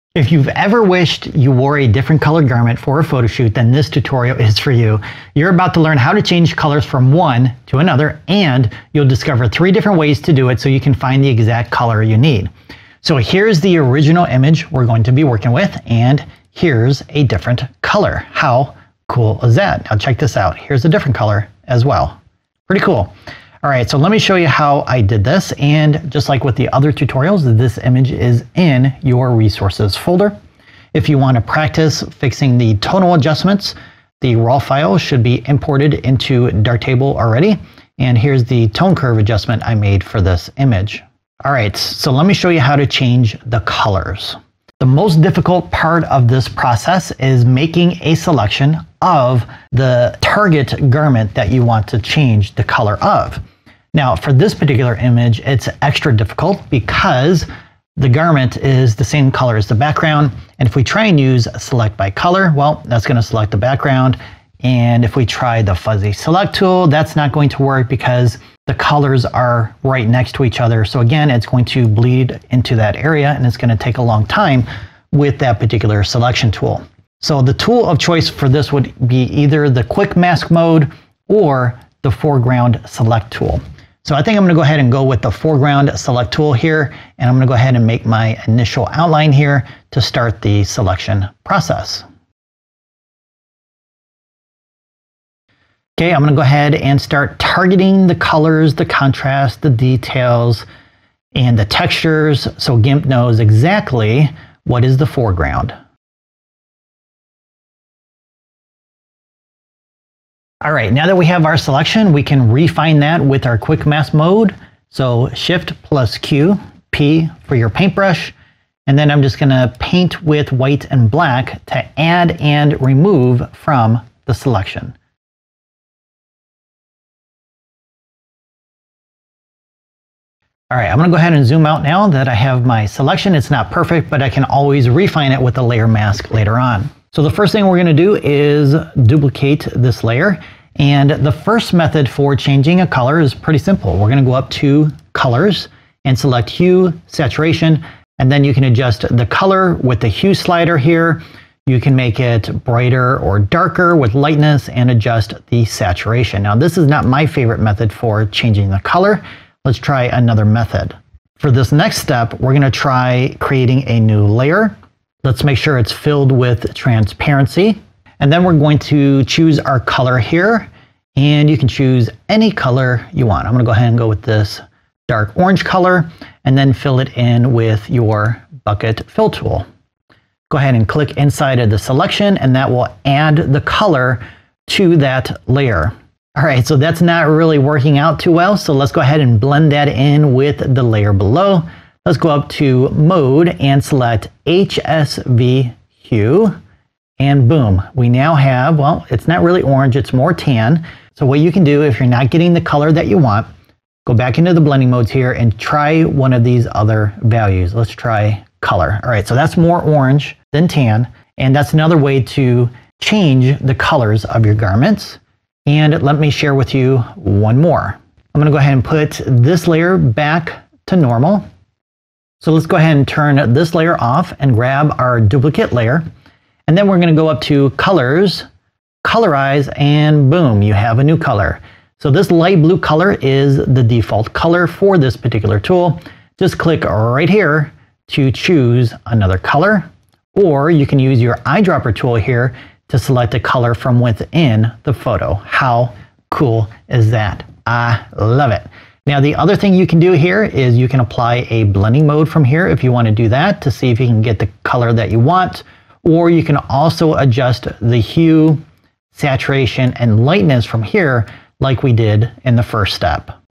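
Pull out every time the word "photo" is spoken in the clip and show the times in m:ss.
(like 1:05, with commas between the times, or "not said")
0:03, 4:04.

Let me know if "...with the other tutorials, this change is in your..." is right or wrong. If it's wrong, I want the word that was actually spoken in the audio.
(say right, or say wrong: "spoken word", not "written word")
wrong: "image", not "change".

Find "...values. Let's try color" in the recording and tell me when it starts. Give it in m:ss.
3:27.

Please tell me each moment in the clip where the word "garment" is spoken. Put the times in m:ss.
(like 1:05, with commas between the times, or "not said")
0:02, 0:50, 0:58, 3:34.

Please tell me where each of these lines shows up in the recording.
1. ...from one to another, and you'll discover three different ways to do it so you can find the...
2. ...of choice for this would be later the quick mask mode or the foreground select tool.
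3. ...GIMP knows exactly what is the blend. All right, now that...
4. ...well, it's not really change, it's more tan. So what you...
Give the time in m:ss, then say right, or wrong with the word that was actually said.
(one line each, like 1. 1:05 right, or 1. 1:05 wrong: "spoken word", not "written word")
1. 0:06 right
2. 1:17 wrong: "either", not "later"
3. 1:42 wrong: "foreground", not "blend"
4. 3:18 wrong: "orange", not "change".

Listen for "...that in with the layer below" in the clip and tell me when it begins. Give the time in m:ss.
3:09.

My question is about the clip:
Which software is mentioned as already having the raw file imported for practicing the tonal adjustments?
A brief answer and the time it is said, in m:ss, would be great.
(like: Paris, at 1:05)
Darktable, at 0:36.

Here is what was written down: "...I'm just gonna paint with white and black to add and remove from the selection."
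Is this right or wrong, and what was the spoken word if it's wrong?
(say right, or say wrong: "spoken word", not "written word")
right.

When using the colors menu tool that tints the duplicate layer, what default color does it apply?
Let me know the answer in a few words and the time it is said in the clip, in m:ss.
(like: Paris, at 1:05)
Light blue, at 3:52.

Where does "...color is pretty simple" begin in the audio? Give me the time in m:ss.
2:22.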